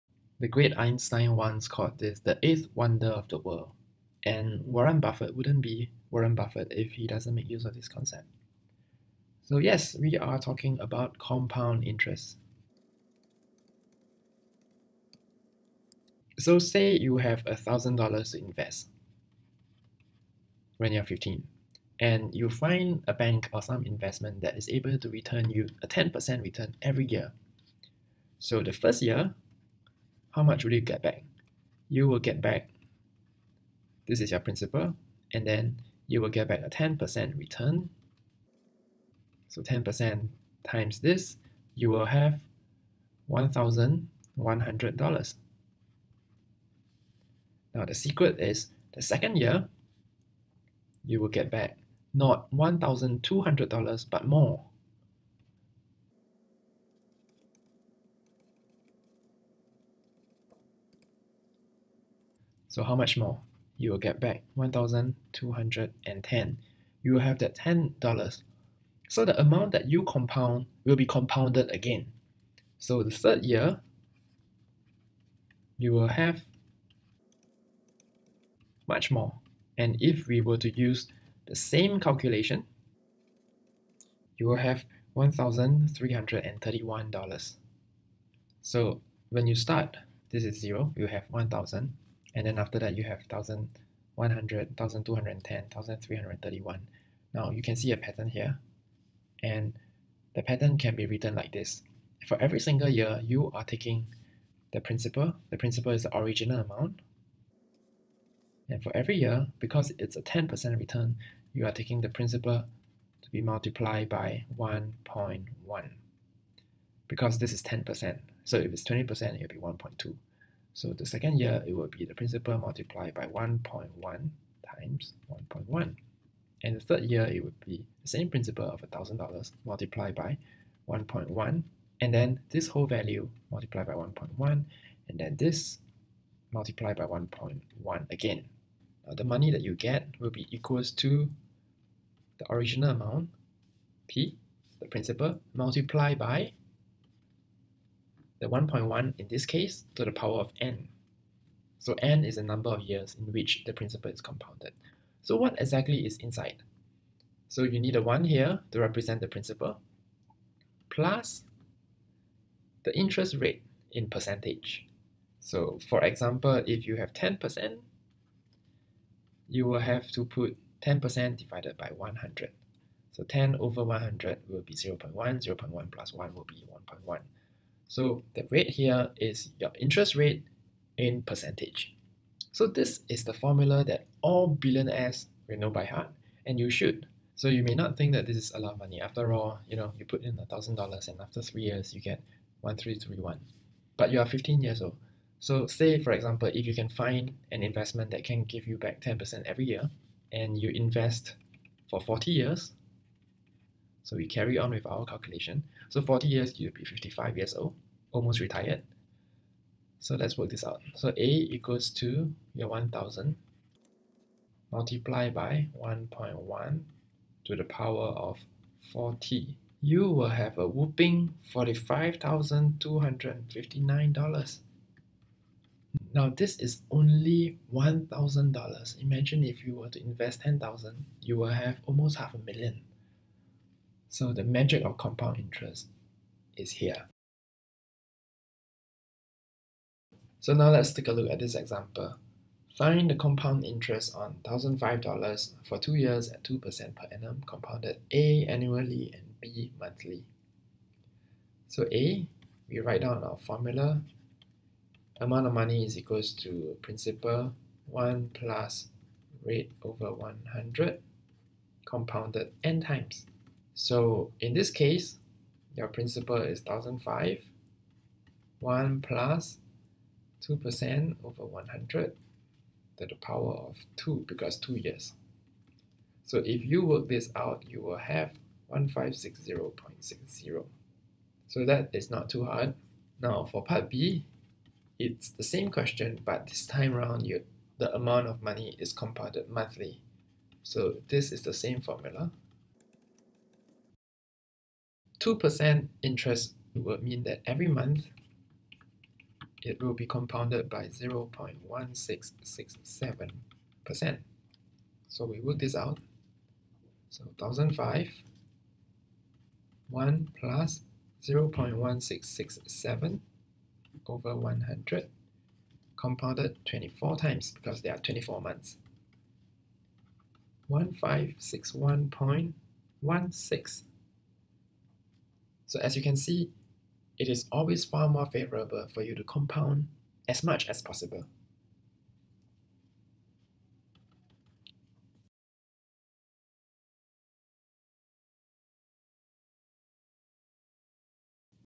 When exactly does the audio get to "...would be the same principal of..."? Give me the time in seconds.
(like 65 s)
127 s.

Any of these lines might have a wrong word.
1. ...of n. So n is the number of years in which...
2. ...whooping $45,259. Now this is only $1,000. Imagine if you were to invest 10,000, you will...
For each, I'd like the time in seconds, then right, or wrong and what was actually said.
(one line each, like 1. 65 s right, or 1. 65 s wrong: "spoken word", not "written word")
1. 150 s right
2. 220 s right.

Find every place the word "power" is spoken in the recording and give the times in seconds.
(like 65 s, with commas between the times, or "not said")
150 s, 217 s, 273 s.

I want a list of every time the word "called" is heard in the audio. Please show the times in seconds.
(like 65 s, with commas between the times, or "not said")
1 s.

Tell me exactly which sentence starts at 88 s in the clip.
So when you start, this is 0, you have 1,000 and then after that you have 1100, 1210, 1331.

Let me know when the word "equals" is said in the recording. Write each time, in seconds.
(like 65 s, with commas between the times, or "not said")
140 s, 211 s, 255 s.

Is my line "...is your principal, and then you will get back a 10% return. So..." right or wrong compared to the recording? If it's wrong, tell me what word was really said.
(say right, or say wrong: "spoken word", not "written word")
right.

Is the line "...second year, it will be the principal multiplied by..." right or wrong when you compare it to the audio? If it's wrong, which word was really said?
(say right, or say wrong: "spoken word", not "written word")
right.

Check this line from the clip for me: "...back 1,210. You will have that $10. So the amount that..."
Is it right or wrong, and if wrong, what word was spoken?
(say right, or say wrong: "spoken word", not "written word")
right.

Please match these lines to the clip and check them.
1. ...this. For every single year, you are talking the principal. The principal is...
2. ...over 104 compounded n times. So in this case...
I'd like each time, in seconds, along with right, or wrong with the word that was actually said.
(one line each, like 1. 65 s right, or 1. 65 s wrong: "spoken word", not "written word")
1. 101 s wrong: "taking", not "talking"
2. 259 s wrong: "100", not "104".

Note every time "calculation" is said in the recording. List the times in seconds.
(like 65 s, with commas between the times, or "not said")
81 s, 205 s.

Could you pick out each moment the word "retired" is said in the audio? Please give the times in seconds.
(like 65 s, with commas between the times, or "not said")
208 s.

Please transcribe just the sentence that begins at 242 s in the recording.
Find the compound interest on $1,005 for 2 years at 2% per annum compounded A annually and B monthly.